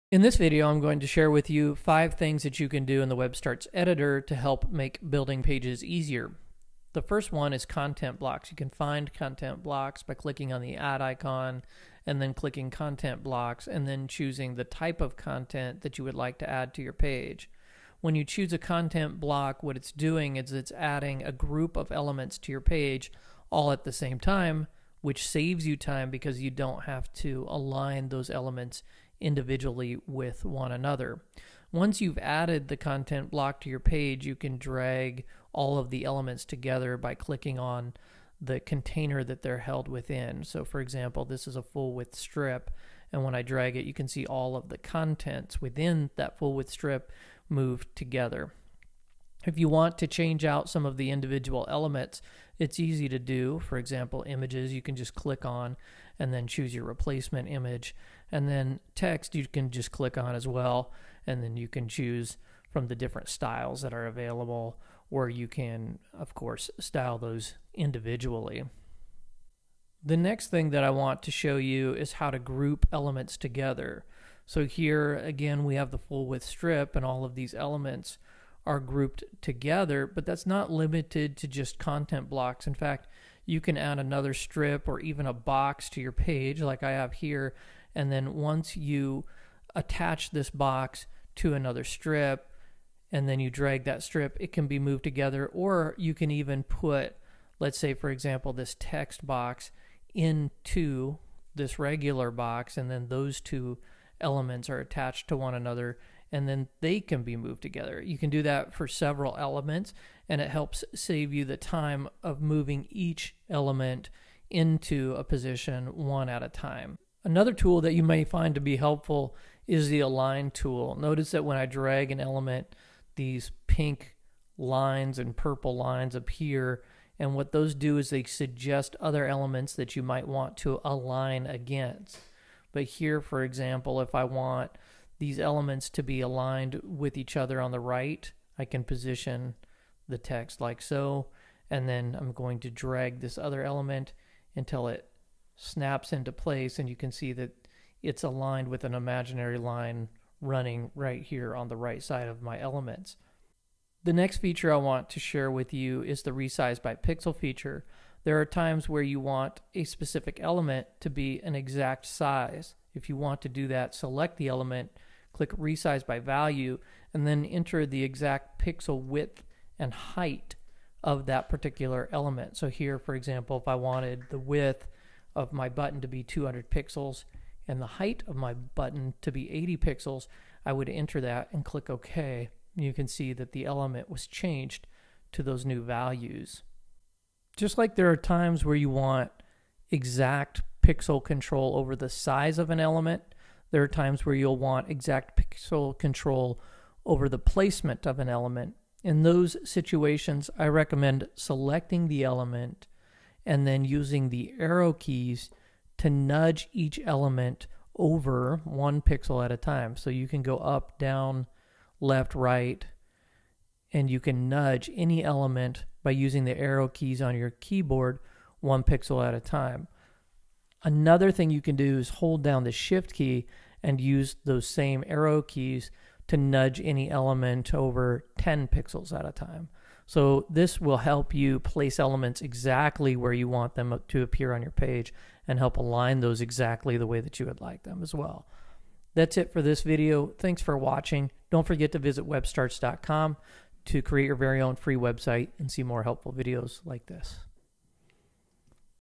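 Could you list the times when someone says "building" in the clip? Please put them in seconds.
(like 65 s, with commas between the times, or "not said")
5 s.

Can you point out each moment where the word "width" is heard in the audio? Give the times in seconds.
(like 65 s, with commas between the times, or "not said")
41 s, 46 s, 76 s, 169 s, 174 s.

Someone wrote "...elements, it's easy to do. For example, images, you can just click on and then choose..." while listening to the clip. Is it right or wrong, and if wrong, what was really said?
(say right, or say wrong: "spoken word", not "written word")
right.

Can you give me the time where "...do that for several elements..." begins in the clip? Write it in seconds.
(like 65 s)
108 s.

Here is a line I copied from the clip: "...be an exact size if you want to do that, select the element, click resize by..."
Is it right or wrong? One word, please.
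right.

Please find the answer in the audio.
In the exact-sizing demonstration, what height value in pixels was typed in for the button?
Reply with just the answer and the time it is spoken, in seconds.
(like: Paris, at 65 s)
80, at 179 s.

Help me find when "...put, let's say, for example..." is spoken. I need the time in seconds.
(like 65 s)
96 s.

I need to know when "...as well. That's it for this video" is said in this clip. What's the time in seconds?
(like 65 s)
238 s.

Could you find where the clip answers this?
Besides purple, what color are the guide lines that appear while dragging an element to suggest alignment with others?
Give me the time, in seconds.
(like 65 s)
123 s.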